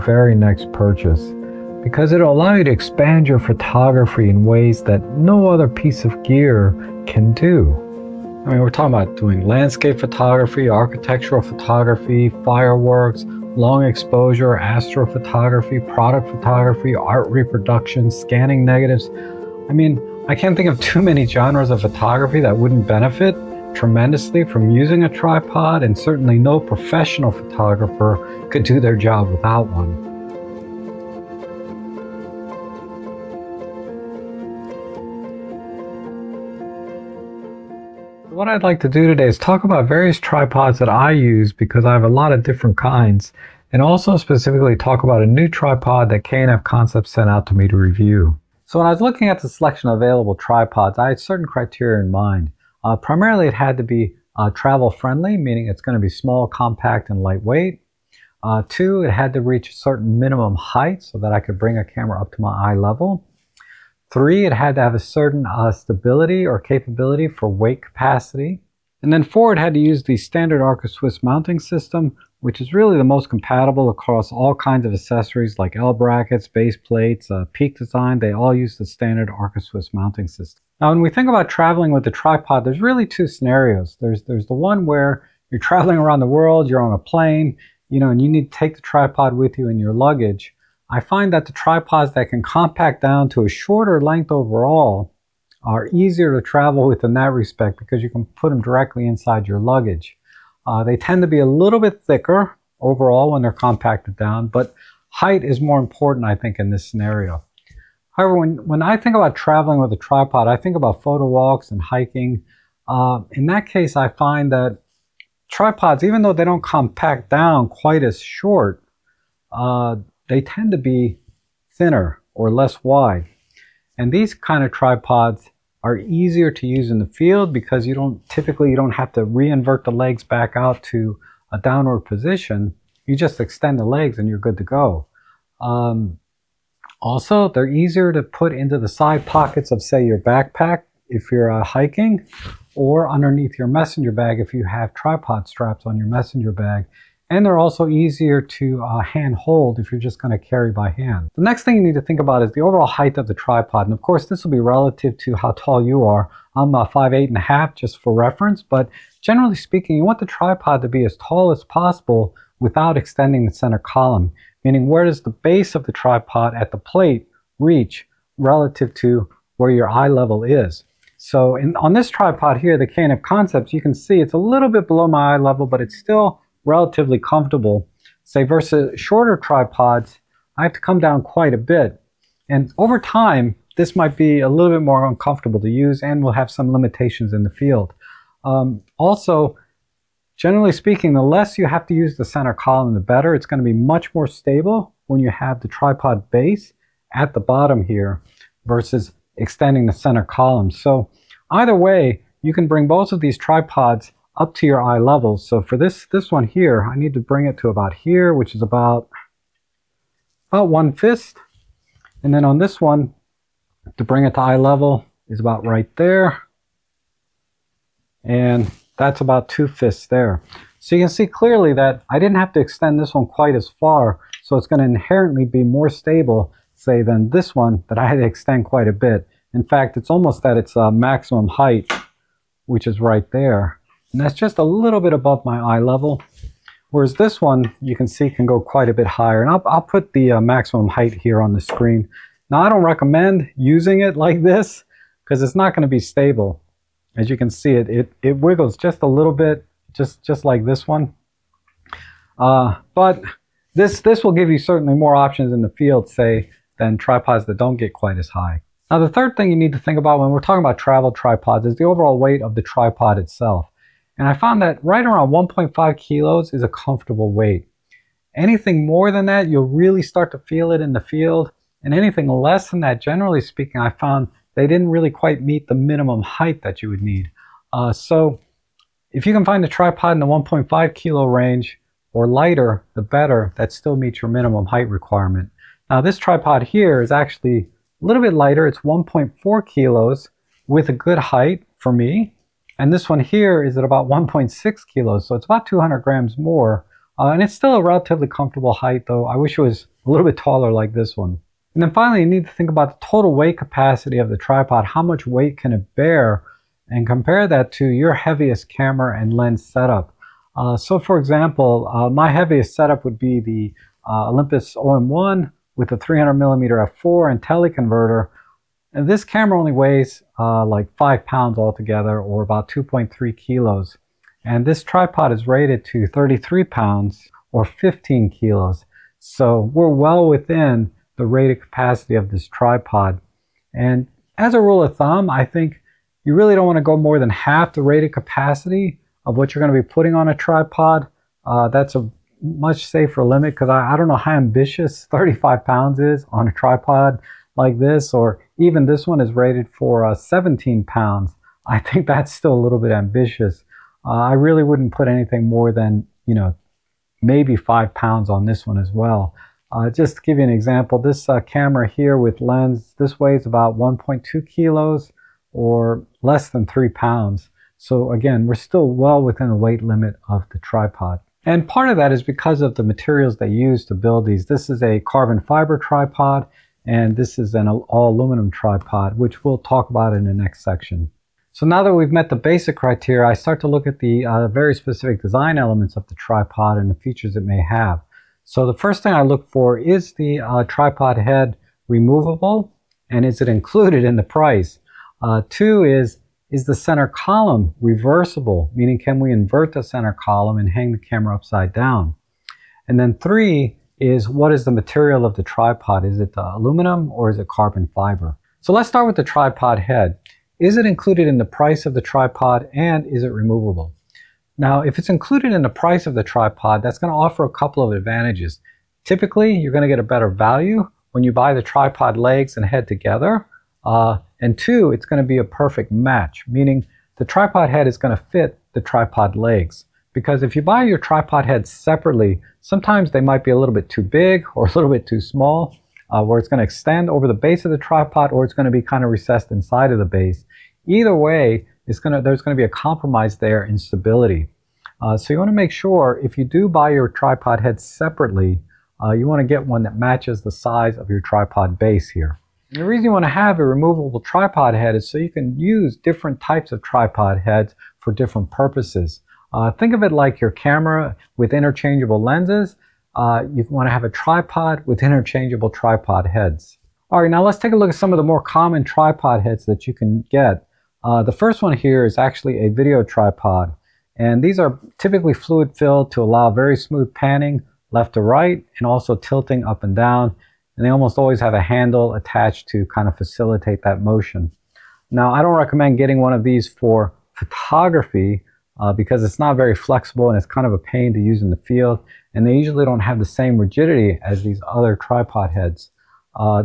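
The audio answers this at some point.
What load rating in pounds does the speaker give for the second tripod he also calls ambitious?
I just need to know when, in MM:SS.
05:50.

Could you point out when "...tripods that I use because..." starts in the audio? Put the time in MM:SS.
00:40.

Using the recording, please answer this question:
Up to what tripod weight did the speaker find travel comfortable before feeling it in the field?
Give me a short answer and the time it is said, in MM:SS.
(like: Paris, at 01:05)
1.5 kilos, at 04:24.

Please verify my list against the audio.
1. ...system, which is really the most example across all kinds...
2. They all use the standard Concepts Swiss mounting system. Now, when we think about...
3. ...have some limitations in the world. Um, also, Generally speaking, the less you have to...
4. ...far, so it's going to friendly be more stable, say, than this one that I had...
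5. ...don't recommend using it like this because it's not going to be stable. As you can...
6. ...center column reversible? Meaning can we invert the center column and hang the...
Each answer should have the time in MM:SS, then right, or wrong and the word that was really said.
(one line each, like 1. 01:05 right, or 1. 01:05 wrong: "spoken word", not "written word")
1. 01:11 wrong: "compatible", not "example"
2. 01:18 wrong: "Arca", not "Concepts"
3. 03:06 wrong: "field", not "world"
4. 03:43 wrong: "inherently", not "friendly"
5. 04:02 right
6. 06:36 right.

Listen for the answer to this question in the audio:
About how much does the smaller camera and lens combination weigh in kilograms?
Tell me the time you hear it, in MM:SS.
06:03.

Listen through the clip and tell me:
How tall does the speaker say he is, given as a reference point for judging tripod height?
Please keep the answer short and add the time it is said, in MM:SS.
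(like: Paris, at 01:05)
five eight and a half, at 02:36.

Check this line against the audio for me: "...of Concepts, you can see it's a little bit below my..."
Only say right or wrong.
right.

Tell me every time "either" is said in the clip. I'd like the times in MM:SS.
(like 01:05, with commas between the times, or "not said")
03:21, 07:20.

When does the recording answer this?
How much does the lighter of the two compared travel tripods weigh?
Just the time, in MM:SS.
04:48.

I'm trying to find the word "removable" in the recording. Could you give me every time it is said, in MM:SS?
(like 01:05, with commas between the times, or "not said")
06:31, 06:53, 07:33.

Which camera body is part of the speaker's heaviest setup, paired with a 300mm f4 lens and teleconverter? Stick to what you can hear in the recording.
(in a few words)
Olympus OM1.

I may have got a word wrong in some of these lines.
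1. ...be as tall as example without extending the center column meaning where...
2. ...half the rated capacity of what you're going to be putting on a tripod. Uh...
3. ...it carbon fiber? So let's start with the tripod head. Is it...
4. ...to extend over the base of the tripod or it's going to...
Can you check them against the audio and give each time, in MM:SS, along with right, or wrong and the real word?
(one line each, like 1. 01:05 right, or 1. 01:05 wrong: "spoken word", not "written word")
1. 02:40 wrong: "possible", not "example"
2. 05:37 right
3. 06:47 right
4. 07:16 right.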